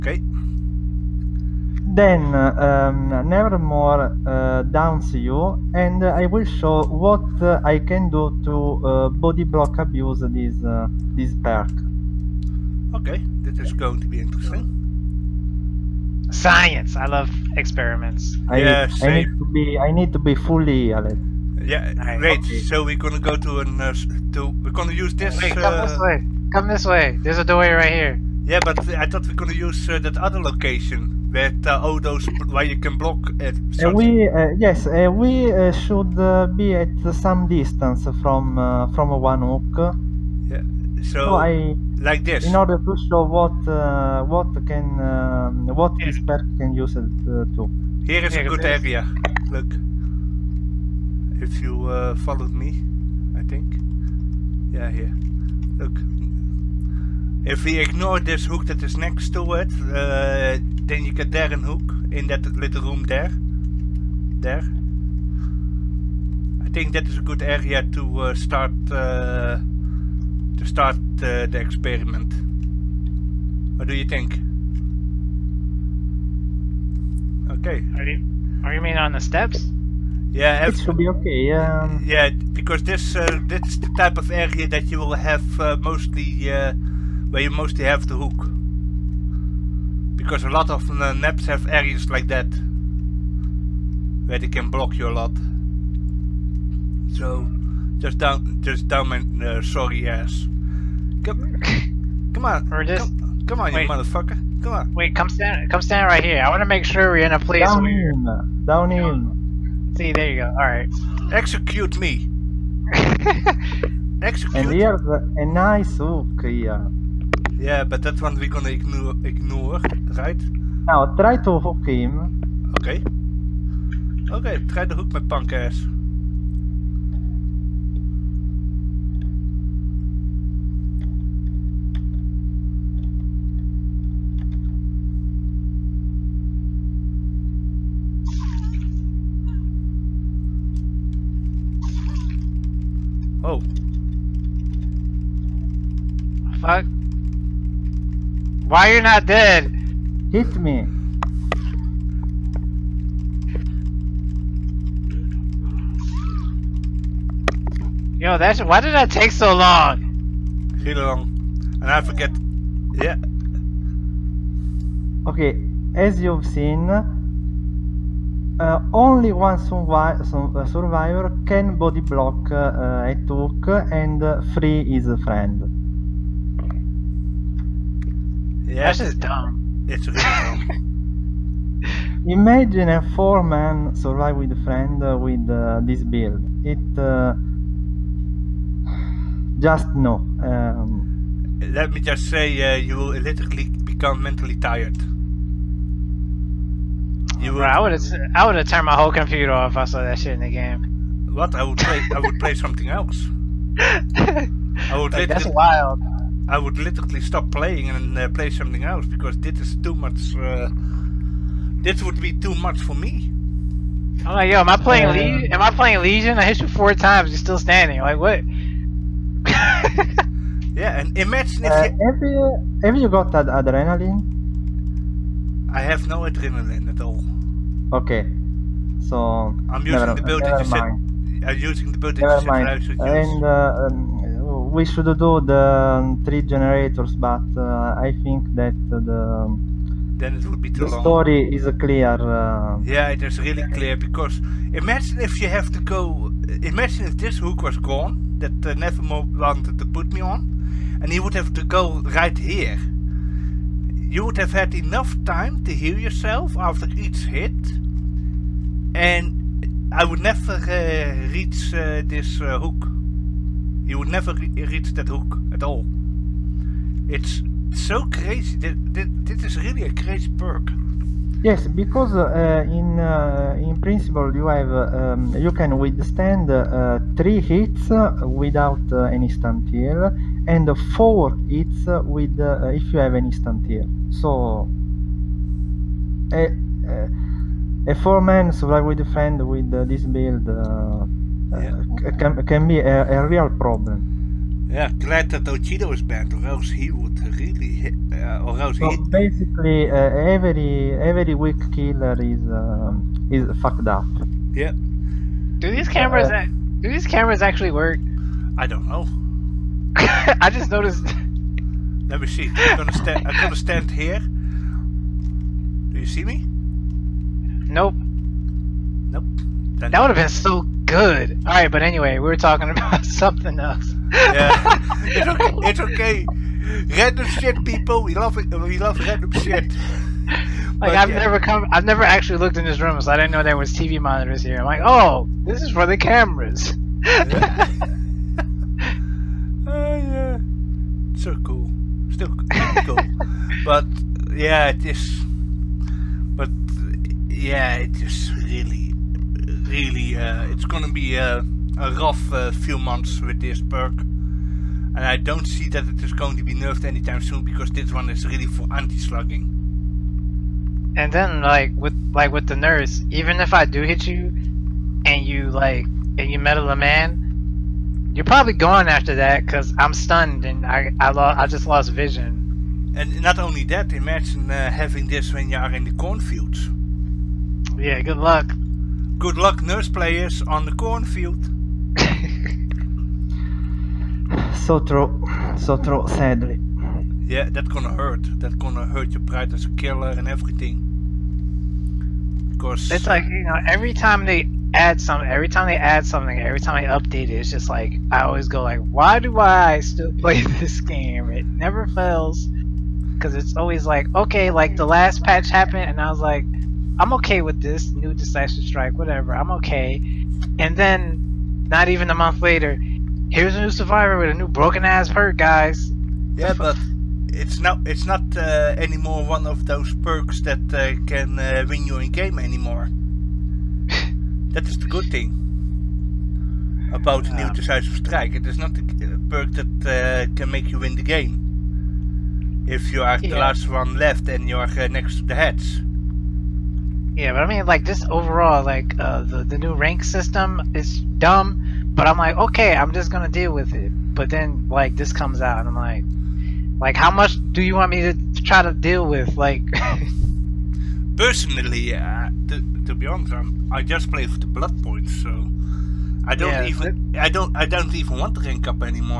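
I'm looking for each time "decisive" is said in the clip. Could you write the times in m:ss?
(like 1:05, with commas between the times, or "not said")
6:48, 7:07.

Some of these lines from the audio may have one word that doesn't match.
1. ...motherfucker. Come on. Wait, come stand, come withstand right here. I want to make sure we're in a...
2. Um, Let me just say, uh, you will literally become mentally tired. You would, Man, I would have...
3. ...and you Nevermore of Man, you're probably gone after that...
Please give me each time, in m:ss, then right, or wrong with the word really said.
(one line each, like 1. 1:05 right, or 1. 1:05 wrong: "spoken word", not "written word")
1. 1:43 wrong: "stand", not "withstand"
2. 3:10 wrong: "Bro", not "Man"
3. 6:06 wrong: "Mettle", not "Nevermore".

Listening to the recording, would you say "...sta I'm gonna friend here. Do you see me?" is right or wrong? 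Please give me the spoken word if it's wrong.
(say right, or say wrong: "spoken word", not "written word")
wrong: "stand", not "friend".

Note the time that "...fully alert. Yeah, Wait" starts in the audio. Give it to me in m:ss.
0:20.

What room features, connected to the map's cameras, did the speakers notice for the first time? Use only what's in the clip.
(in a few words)
TV monitors.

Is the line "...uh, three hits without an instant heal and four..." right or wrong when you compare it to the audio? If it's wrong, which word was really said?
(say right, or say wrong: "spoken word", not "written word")
right.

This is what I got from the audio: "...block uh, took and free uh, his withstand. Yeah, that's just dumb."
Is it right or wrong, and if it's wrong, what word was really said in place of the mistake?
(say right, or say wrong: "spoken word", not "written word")
wrong: "friend", not "withstand".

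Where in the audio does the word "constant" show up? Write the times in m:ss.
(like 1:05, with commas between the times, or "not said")
not said.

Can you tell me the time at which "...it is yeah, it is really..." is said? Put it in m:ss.
5:44.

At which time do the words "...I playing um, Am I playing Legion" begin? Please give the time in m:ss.
3:34.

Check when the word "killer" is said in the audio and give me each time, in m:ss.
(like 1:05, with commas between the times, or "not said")
5:01, 6:29.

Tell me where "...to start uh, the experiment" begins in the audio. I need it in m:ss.
1:10.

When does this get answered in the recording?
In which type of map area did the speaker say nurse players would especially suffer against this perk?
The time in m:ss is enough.
6:15.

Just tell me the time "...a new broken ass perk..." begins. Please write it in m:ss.
6:54.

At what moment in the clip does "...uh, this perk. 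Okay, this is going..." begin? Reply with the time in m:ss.
0:10.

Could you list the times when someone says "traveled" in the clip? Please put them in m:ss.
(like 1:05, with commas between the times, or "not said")
not said.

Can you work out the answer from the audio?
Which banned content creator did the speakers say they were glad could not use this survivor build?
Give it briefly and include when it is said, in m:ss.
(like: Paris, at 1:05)
Ochido, at 4:55.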